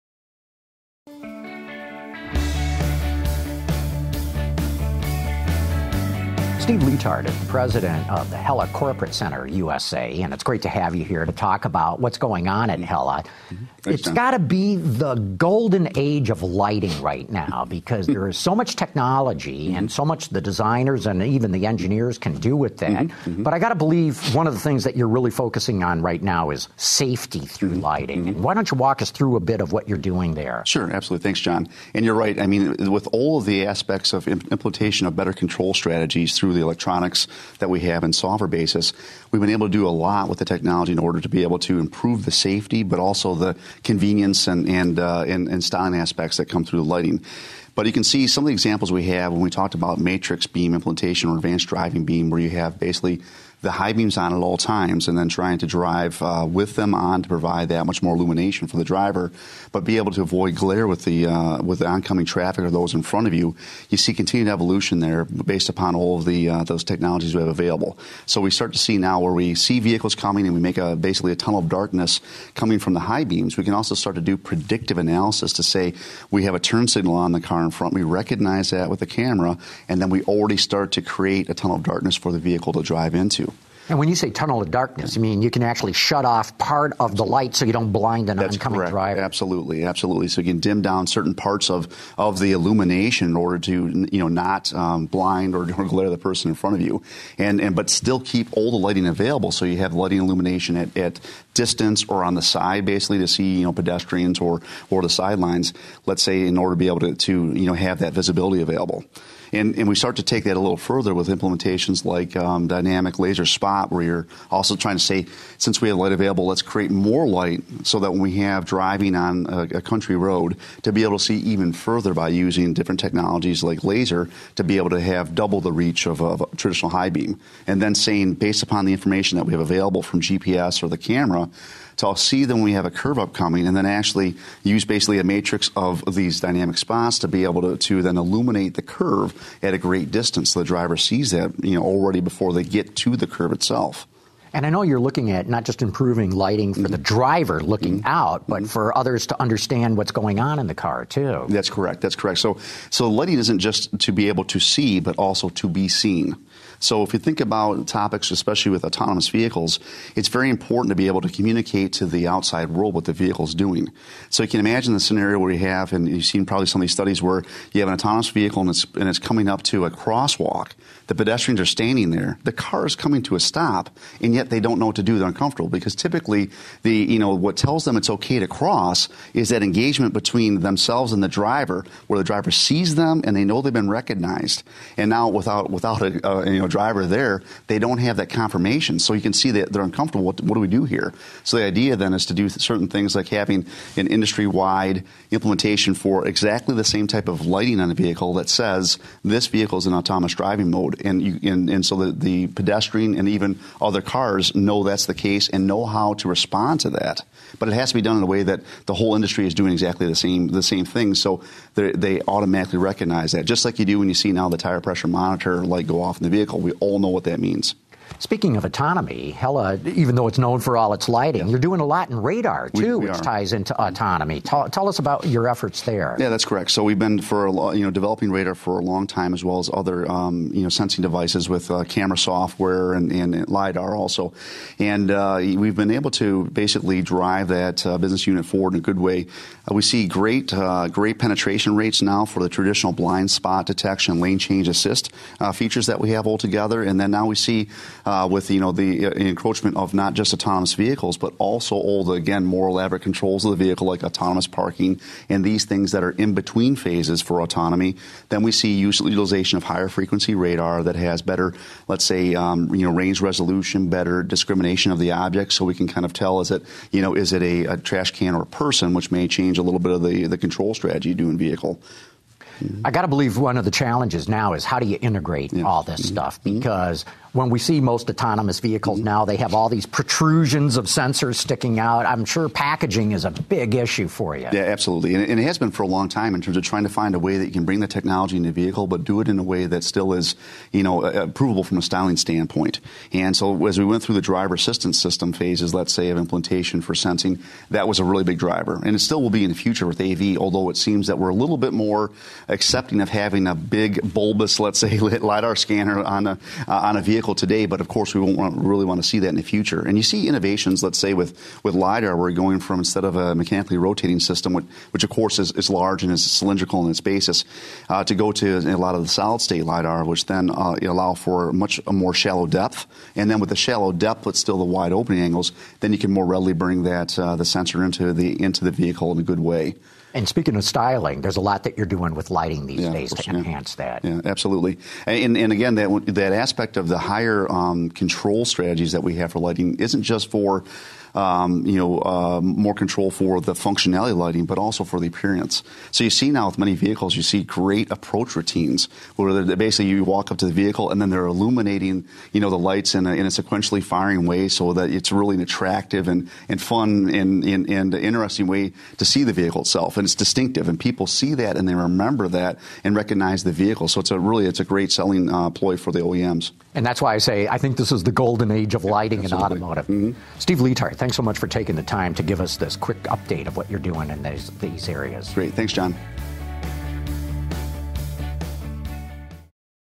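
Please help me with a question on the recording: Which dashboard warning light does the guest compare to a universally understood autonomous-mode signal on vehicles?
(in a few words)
tire pressure monitor light.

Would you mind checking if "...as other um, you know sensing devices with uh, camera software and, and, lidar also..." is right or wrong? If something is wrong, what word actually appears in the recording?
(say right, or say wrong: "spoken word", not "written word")
right.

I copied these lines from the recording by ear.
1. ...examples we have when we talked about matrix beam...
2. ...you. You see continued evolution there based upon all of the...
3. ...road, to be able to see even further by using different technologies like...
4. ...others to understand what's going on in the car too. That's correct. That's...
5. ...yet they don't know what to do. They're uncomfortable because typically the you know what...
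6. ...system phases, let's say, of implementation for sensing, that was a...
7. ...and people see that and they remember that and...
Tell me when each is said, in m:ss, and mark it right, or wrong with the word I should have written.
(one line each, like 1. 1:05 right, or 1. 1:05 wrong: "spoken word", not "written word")
1. 0:48 right
2. 1:03 right
3. 2:00 right
4. 2:28 right
5. 2:54 right
6. 4:55 right
7. 6:00 right.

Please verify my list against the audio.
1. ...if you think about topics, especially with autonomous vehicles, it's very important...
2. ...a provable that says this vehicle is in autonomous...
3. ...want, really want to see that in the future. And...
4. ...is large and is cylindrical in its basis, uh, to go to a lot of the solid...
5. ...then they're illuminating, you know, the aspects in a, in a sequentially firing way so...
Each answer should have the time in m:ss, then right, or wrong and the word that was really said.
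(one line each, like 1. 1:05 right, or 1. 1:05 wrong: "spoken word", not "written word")
1. 2:37 right
2. 3:17 wrong: "vehicle", not "provable"
3. 5:08 right
4. 5:15 right
5. 5:51 wrong: "lights", not "aspects".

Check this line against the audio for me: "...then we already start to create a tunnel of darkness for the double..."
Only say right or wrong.
wrong.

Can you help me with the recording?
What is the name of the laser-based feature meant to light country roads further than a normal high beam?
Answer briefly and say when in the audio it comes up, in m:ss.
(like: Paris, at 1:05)
dynamic laser spot, at 1:52.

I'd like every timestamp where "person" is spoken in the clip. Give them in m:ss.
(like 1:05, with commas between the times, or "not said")
1:36, 4:28.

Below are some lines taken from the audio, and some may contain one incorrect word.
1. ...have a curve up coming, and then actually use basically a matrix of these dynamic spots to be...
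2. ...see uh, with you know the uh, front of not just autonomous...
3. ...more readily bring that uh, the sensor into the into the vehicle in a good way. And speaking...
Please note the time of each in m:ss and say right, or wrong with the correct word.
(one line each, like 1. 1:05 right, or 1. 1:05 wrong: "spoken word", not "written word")
1. 2:12 right
2. 4:07 wrong: "encroachment", not "front"
3. 5:26 right.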